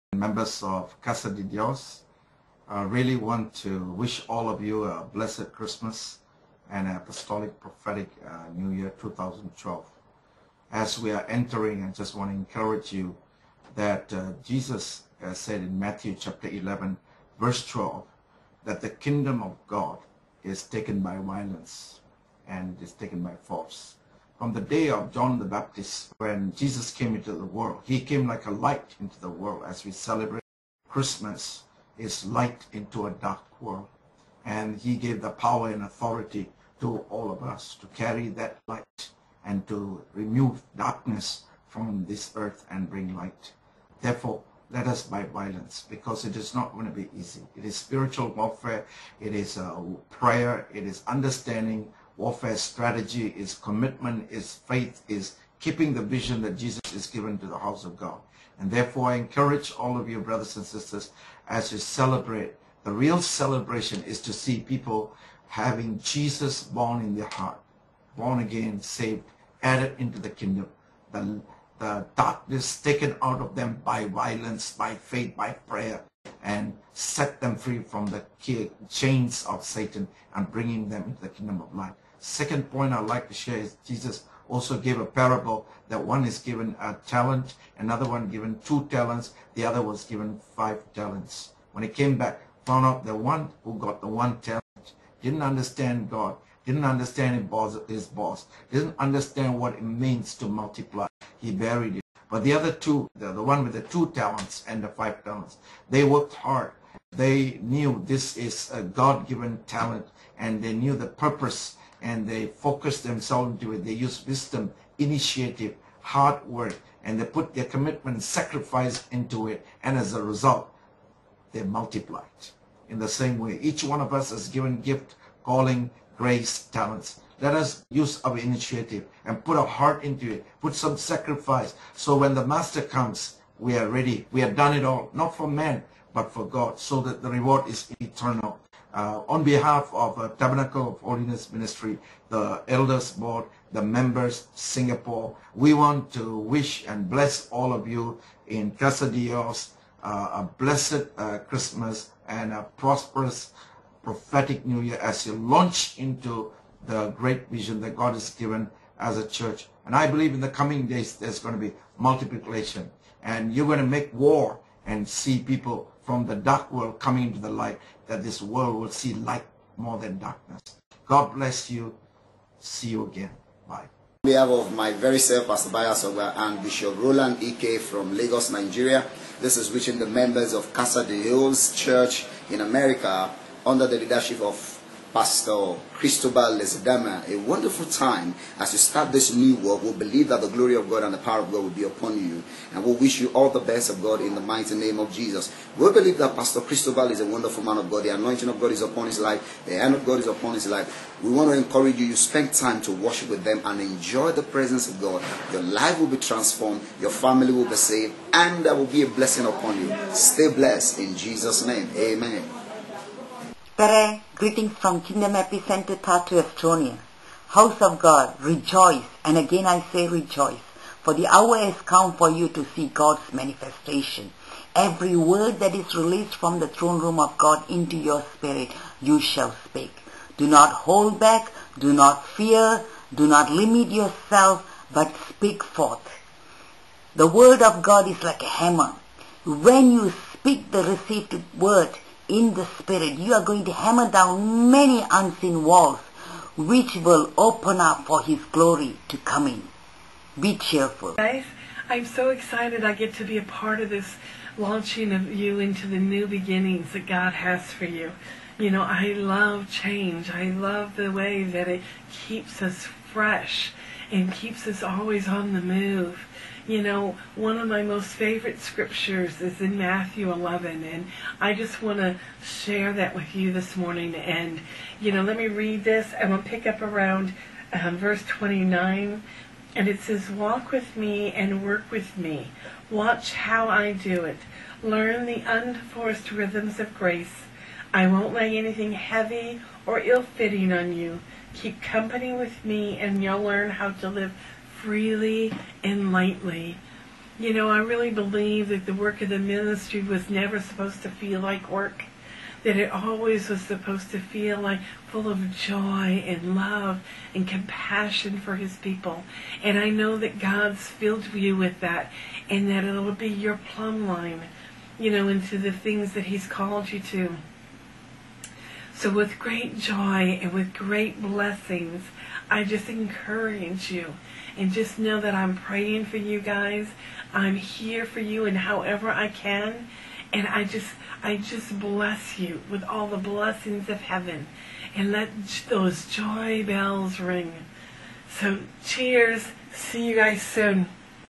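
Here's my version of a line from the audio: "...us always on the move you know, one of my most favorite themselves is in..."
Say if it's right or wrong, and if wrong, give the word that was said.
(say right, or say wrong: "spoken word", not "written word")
wrong: "scriptures", not "themselves".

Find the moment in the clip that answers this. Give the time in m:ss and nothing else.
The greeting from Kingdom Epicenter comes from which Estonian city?
3:35.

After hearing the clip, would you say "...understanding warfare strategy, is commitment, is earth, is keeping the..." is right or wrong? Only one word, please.
wrong.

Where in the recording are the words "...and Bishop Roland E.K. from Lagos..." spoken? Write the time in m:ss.
2:56.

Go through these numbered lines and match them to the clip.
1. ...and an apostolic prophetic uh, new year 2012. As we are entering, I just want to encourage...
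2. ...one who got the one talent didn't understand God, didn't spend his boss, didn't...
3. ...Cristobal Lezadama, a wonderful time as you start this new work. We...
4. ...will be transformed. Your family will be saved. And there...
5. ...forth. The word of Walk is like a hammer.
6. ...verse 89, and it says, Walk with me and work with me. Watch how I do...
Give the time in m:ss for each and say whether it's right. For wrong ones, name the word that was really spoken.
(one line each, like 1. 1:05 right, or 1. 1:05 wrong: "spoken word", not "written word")
1. 0:06 right
2. 1:33 wrong: "understand", not "spend"
3. 3:05 right
4. 3:25 right
5. 3:55 wrong: "God", not "Walk"
6. 4:37 wrong: "29", not "89".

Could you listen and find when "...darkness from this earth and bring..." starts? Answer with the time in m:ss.
0:40.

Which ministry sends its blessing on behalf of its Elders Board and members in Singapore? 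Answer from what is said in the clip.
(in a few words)
Tabernacle of Holiness Ministry.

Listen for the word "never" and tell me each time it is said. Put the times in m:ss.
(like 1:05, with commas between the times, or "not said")
5:00.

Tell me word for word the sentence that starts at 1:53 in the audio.
They use wisdom, initiative, hard work, and they put their commitment, sacrifice into it, and as a result, they multiplied.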